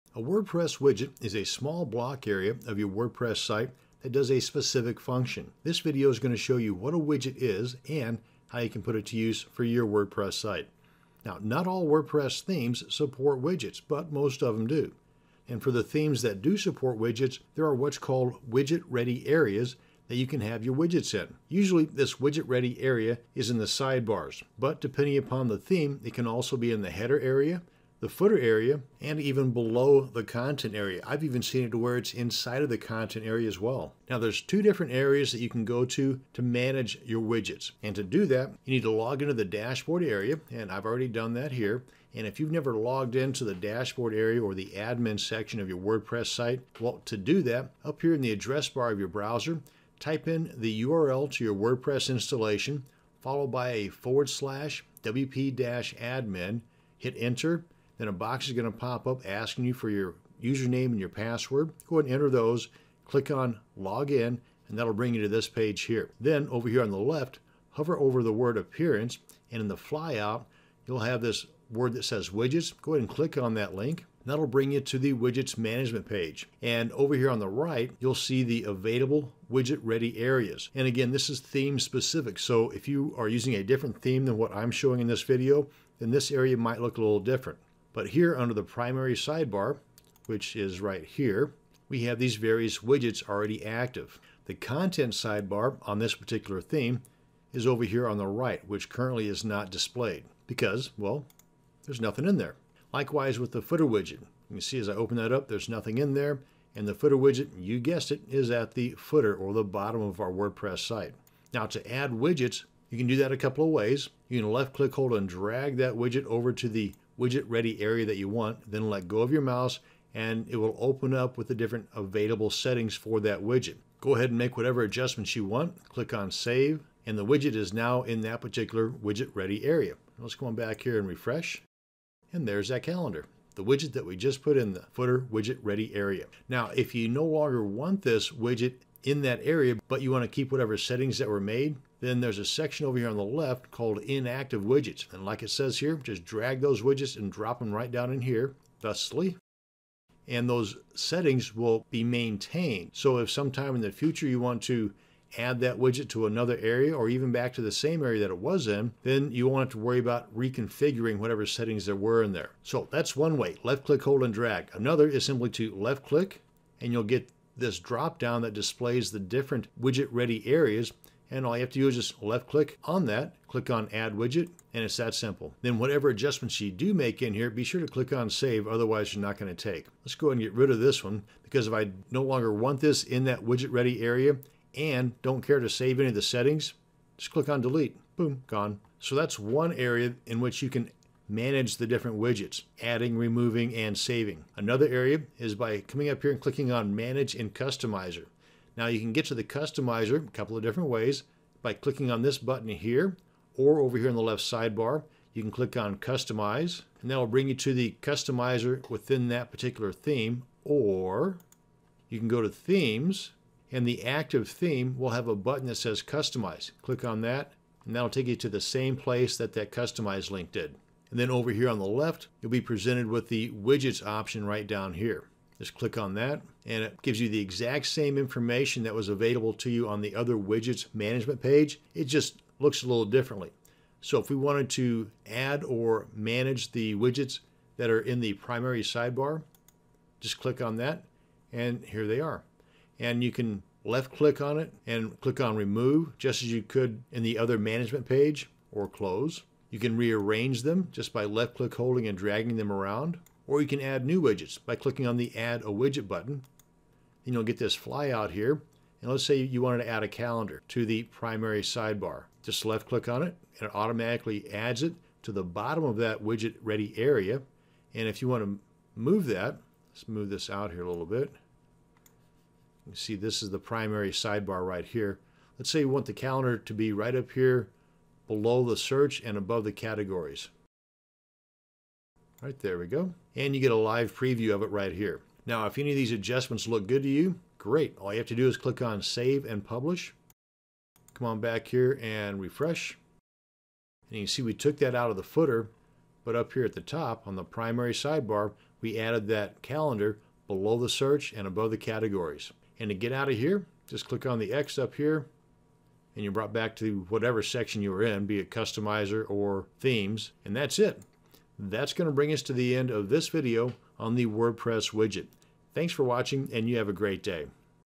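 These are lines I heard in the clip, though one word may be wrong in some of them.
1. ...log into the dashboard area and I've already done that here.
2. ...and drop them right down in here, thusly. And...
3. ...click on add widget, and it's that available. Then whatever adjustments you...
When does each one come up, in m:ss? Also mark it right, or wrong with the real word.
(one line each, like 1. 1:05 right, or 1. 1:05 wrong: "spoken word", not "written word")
1. 0:38 right
2. 2:27 right
3. 2:53 wrong: "simple", not "available".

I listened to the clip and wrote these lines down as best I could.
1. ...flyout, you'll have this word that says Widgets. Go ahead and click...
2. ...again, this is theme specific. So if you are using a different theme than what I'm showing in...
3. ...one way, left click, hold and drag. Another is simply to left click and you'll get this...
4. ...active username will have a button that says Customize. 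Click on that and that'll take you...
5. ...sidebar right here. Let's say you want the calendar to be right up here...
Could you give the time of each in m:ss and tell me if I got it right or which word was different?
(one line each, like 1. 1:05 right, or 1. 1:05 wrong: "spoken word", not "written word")
1. 1:09 right
2. 1:20 right
3. 2:43 right
4. 3:34 wrong: "theme", not "username"
5. 4:34 right.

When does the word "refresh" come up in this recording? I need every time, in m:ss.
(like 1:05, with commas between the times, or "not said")
2:11, 4:52.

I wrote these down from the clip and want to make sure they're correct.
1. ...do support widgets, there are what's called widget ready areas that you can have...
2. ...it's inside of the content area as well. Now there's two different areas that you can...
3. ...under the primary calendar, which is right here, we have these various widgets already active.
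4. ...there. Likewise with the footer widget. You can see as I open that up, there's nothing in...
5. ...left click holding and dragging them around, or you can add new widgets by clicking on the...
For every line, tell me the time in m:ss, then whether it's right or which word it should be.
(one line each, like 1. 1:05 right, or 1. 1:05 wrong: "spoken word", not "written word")
1. 0:16 right
2. 0:31 right
3. 1:28 wrong: "sidebar", not "calendar"
4. 1:42 right
5. 4:11 right.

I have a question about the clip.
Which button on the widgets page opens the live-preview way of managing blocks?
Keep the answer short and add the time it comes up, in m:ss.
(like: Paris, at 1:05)
Manage in Customizer, at 3:16.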